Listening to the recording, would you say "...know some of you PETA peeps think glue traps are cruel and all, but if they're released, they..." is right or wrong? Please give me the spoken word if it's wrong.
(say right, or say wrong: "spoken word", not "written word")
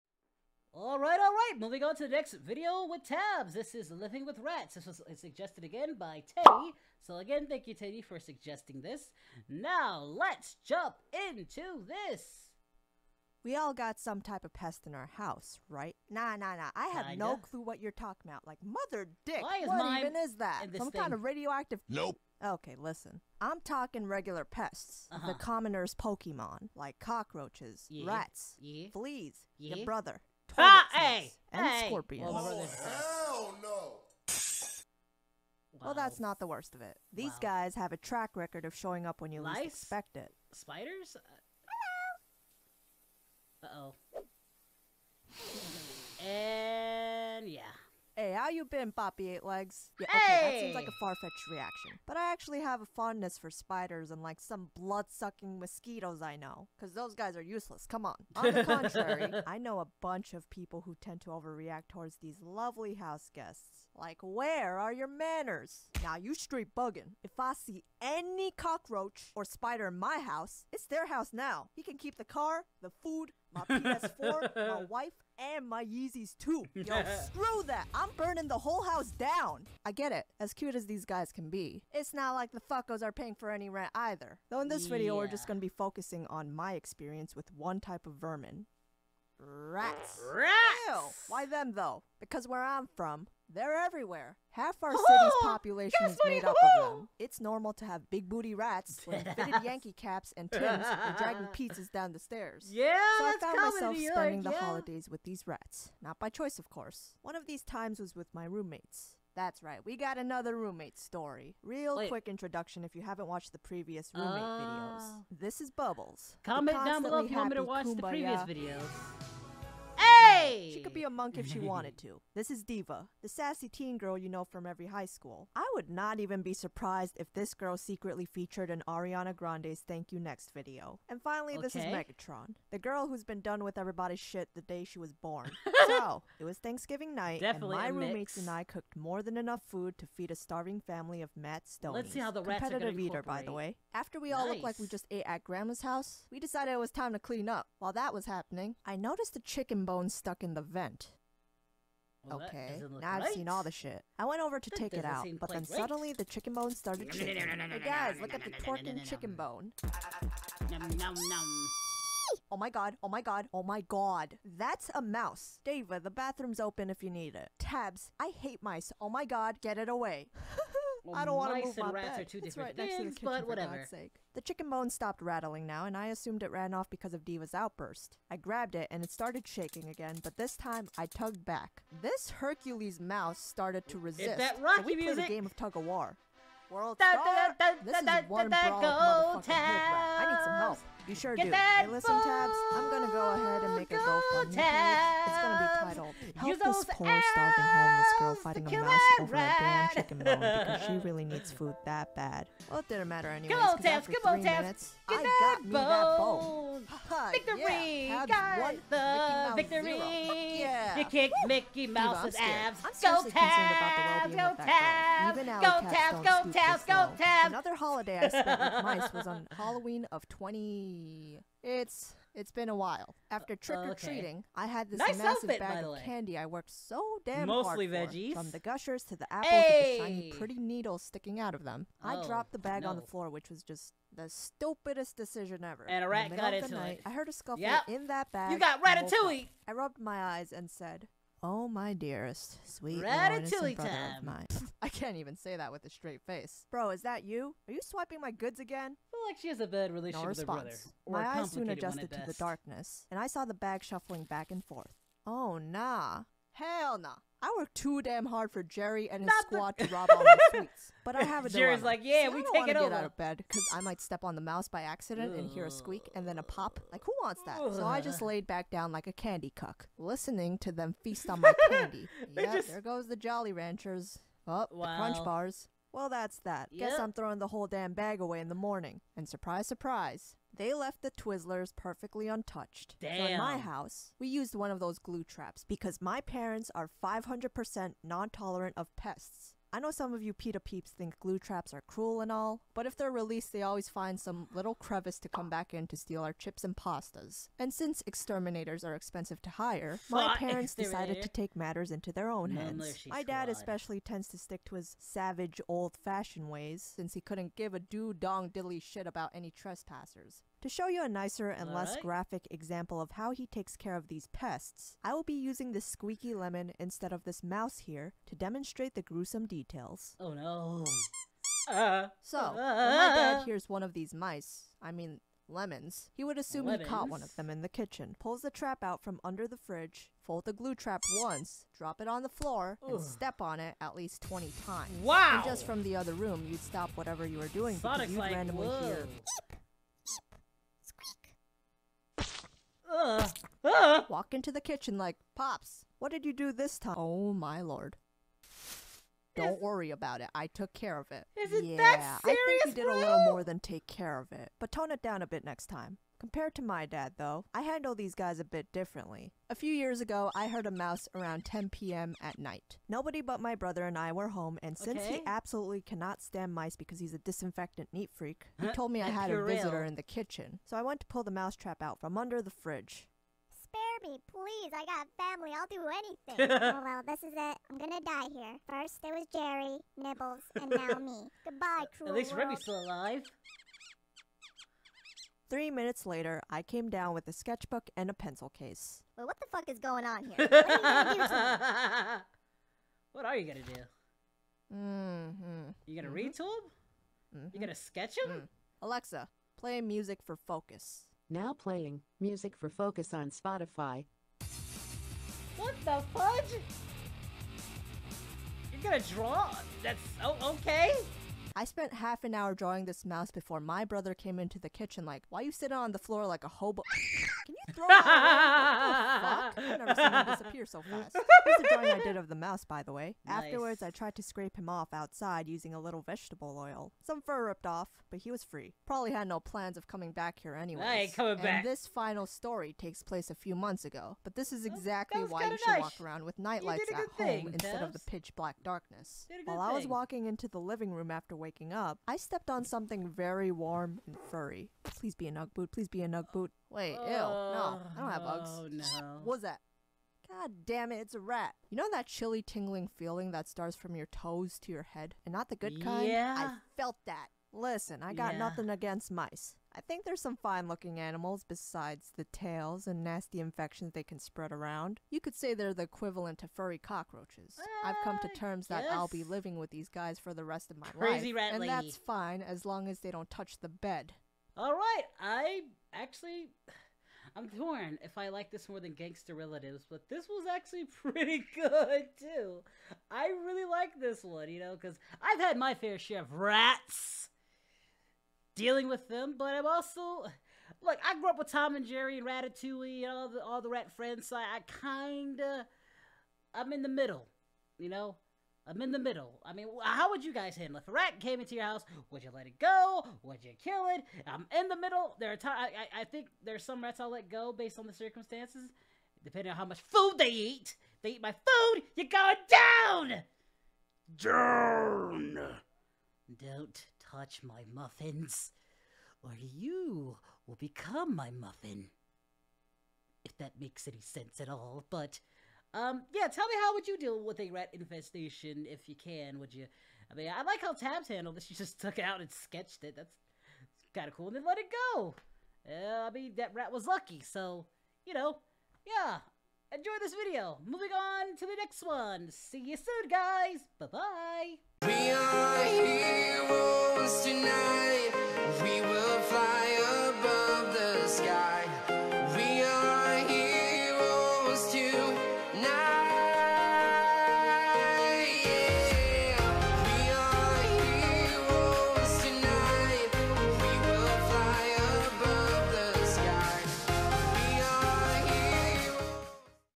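right.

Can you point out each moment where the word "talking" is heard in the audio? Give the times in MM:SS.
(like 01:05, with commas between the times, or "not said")
00:17, 00:23.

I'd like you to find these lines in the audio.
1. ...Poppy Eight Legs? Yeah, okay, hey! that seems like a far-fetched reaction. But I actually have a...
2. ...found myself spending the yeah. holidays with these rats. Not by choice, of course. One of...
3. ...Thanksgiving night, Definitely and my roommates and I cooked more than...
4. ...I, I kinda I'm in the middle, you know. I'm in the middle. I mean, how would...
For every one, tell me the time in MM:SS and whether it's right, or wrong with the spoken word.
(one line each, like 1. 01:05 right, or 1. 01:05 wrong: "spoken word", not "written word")
1. 00:48 right
2. 01:43 right
3. 02:16 right
4. 08:14 right.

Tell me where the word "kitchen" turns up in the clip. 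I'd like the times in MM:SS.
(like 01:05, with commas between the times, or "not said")
02:53, 05:27, 05:44, 06:10, 06:54.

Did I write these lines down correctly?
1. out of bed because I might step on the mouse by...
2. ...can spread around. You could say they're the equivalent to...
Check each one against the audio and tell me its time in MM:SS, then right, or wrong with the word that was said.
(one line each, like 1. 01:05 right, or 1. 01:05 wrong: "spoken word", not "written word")
1. 04:22 right
2. 07:44 right.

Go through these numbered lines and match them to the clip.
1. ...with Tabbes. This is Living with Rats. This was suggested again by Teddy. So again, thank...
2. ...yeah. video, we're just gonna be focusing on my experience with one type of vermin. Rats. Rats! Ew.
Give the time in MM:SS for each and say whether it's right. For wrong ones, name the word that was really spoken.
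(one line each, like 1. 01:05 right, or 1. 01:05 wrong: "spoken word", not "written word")
1. 00:02 right
2. 01:24 right.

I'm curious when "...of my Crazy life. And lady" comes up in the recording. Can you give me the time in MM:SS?
07:50.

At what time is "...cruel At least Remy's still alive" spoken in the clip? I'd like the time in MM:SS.
06:21.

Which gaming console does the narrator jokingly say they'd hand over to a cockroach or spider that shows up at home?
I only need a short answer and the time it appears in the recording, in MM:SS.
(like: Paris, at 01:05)
PS4, at 01:13.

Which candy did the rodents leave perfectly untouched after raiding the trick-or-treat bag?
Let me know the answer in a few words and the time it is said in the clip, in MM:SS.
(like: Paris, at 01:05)
Twizzlers, at 04:41.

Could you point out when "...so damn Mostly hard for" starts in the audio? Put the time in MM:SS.
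03:46.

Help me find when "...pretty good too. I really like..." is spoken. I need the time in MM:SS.
08:00.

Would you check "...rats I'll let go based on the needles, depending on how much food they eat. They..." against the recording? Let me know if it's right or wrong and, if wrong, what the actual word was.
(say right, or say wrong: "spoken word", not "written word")
wrong: "circumstances", not "needles".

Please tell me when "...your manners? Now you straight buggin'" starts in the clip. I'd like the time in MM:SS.
01:04.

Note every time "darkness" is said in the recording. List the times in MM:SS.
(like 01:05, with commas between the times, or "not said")
04:12, 07:18.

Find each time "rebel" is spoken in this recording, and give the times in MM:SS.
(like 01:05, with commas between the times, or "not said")
not said.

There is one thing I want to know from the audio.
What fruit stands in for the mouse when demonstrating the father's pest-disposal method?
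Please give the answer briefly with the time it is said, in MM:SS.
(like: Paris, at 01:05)
Lemon, at 05:16.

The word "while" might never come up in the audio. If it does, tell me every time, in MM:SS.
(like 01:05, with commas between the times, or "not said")
02:27, 03:42, 07:19.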